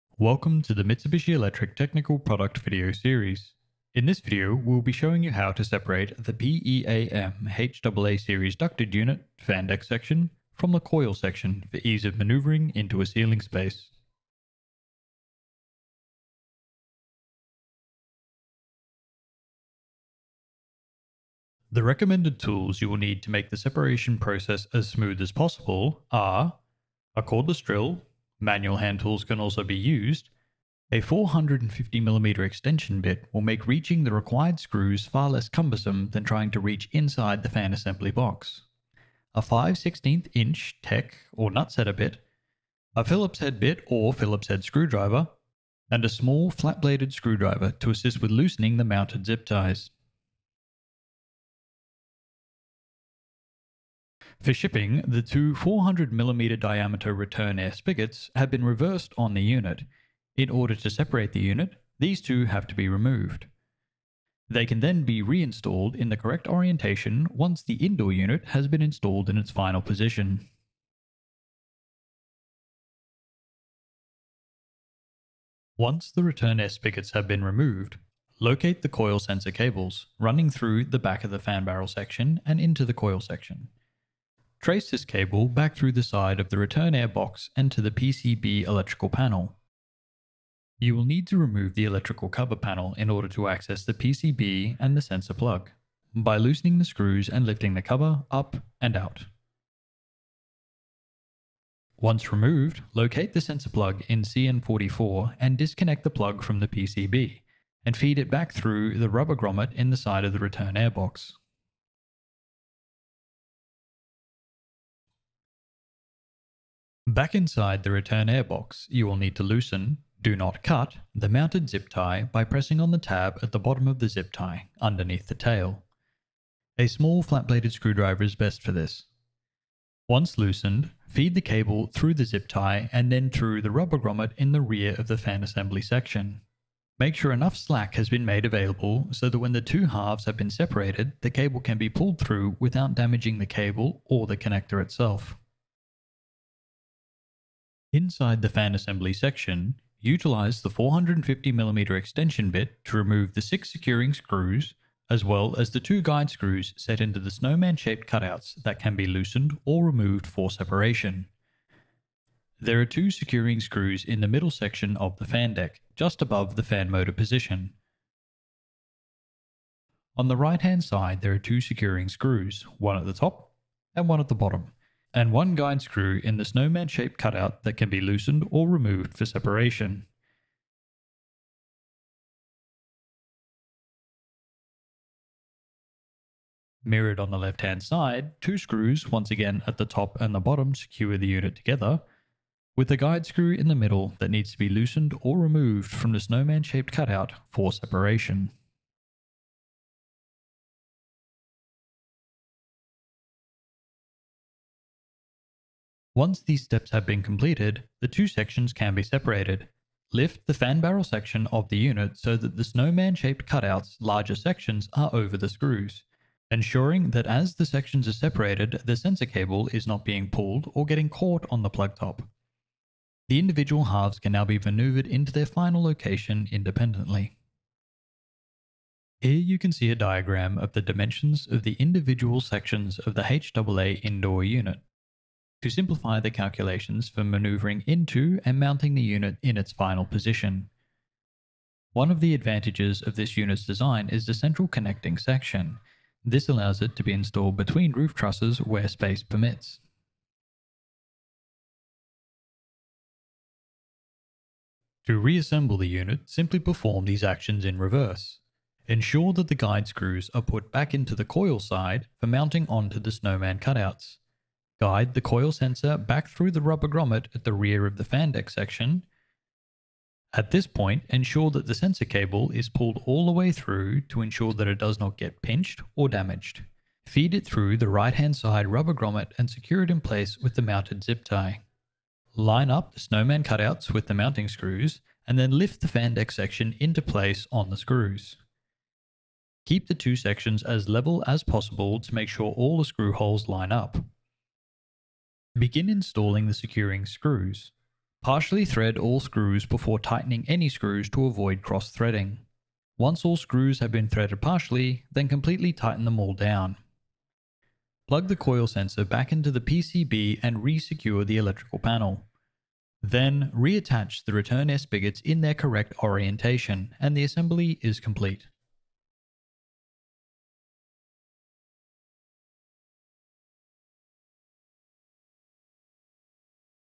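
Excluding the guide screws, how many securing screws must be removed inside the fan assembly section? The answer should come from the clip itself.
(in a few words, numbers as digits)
6.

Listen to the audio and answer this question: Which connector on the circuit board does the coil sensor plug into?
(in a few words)
CN44.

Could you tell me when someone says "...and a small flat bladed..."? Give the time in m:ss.
0:45.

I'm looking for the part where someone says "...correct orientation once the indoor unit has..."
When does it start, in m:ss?
1:06.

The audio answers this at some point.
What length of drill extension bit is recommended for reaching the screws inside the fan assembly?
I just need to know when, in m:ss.
0:30.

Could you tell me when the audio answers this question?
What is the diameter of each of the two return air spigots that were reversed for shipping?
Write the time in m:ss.
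0:55.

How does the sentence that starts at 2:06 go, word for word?
A small flat-bladed screwdriver is best for this.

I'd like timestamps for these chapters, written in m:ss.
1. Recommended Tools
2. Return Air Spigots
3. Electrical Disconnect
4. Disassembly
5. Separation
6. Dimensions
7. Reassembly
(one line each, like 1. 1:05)
1. 0:21
2. 0:54
3. 1:13
4. 2:27
5. 3:25
6. 3:49
7. 4:13.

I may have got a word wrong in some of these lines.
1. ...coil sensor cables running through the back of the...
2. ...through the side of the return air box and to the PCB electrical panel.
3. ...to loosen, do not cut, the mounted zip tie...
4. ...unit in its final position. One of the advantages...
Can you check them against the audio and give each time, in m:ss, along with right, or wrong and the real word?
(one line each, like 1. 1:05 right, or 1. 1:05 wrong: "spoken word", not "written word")
1. 1:18 right
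2. 1:25 right
3. 1:59 right
4. 3:59 right.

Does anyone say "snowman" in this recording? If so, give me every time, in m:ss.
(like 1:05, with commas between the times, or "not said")
2:37, 2:56, 3:16, 3:32, 4:23, 4:42.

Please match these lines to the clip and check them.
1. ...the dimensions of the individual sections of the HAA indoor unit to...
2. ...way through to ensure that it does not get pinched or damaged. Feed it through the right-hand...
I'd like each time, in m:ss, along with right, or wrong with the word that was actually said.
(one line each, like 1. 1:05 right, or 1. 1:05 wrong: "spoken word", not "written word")
1. 3:50 right
2. 4:33 right.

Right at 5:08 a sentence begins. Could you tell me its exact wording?
Plug the coil sensor back into the PCB and re-secure the electrical panel.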